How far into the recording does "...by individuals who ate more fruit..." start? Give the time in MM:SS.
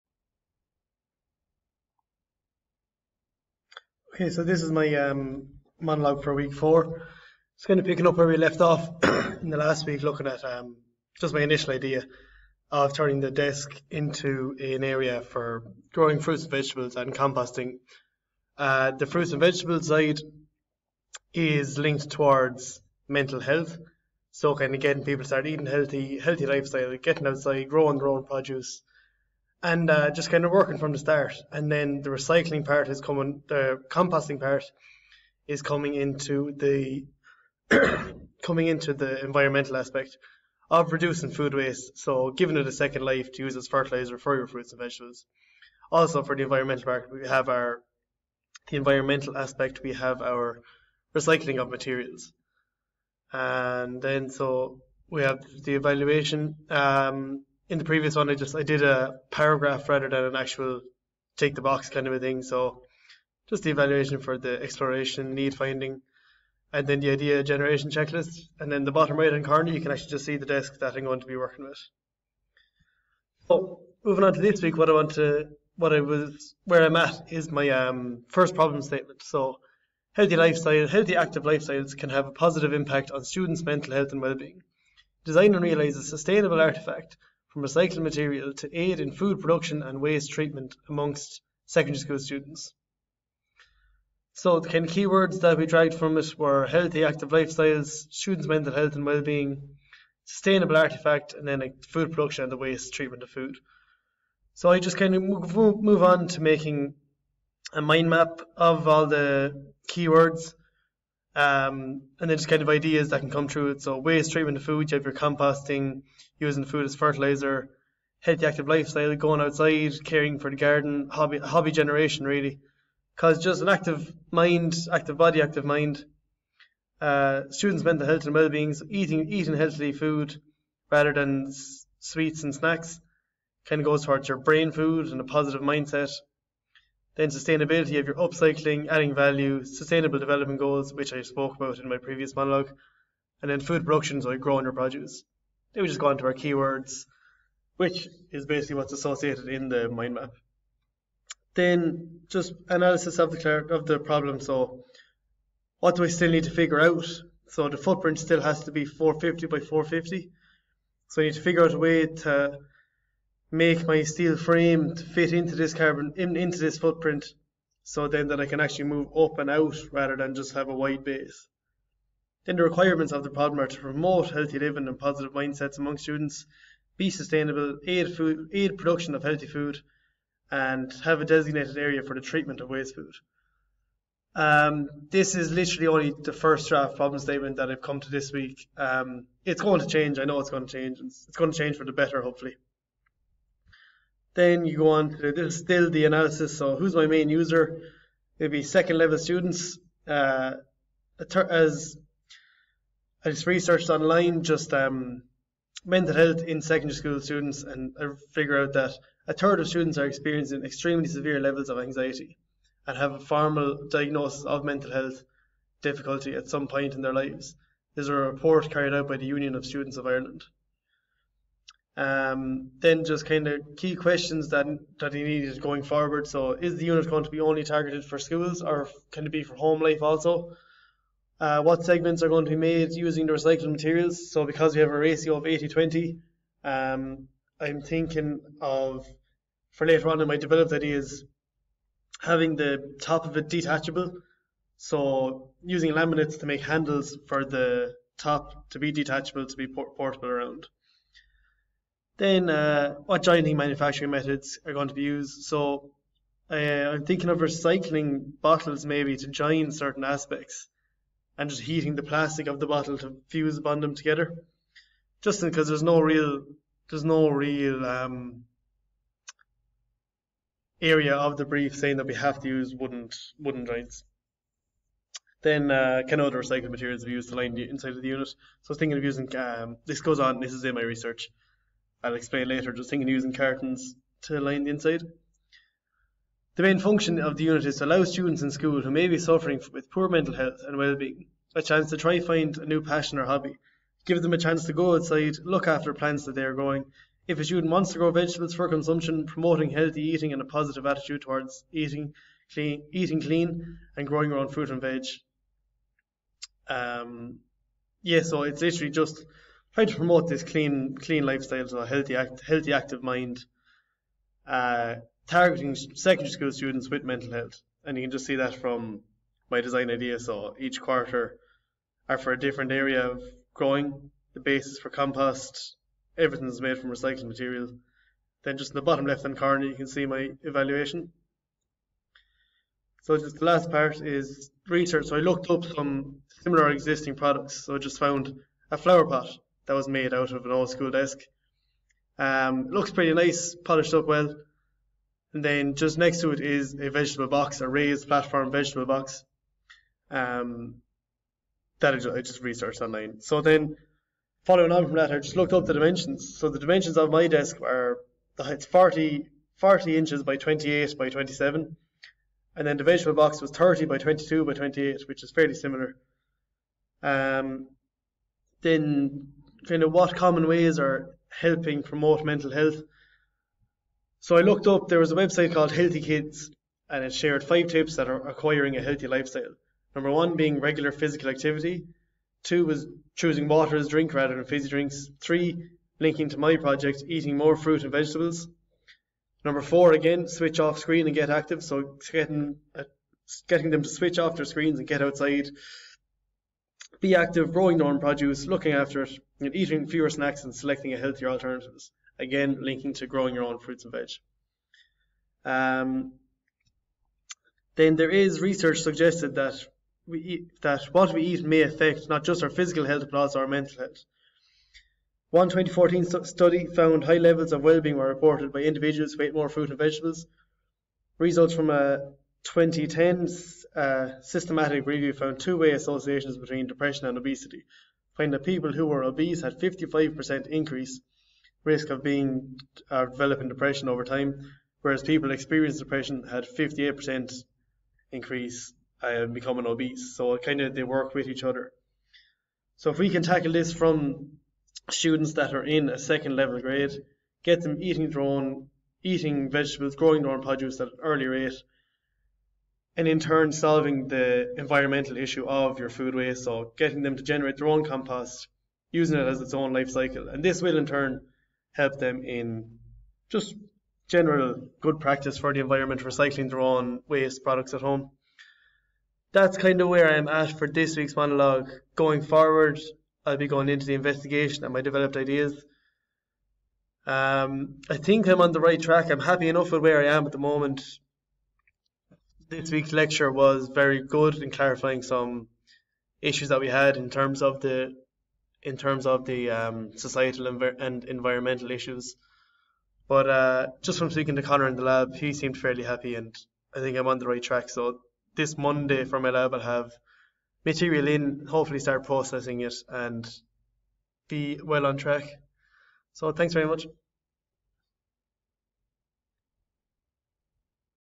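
06:58.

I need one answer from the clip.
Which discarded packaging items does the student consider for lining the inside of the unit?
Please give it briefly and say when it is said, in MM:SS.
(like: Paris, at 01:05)
Cartons, at 04:43.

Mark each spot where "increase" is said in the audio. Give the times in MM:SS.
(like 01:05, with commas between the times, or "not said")
07:10, 07:18.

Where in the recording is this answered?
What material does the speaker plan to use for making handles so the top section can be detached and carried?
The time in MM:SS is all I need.
04:05.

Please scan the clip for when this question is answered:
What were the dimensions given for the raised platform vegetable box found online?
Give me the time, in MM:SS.
06:03.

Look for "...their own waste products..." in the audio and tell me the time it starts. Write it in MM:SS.
07:46.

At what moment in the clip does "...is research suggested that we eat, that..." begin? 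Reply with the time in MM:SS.
06:48.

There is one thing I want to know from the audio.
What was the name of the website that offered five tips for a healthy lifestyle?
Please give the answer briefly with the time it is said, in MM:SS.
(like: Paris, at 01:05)
Healthy Kids, at 06:15.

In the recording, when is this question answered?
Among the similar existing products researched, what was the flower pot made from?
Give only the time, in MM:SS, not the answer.
05:40.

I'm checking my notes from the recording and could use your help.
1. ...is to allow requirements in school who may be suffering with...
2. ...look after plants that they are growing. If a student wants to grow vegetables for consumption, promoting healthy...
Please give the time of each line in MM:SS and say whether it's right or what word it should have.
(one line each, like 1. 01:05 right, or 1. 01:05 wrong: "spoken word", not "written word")
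1. 04:47 wrong: "students", not "requirements"
2. 04:55 right.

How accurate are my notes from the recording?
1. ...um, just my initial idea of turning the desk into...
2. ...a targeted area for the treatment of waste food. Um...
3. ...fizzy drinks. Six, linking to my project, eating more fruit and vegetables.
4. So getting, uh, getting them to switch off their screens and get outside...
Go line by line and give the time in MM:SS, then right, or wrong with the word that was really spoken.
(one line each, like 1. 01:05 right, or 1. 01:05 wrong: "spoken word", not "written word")
1. 00:10 right
2. 03:01 wrong: "designated", not "targeted"
3. 06:24 wrong: "Three", not "Six"
4. 06:31 right.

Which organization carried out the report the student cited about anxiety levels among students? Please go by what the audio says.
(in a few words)
Union of Students of Ireland.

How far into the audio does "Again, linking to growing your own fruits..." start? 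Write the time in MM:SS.
06:42.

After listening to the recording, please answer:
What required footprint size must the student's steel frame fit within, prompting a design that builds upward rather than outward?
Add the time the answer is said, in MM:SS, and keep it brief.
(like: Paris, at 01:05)
450 by 450, at 02:38.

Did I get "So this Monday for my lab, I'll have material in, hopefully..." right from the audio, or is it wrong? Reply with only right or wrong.
right.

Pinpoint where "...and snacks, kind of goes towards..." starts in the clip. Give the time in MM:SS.
02:12.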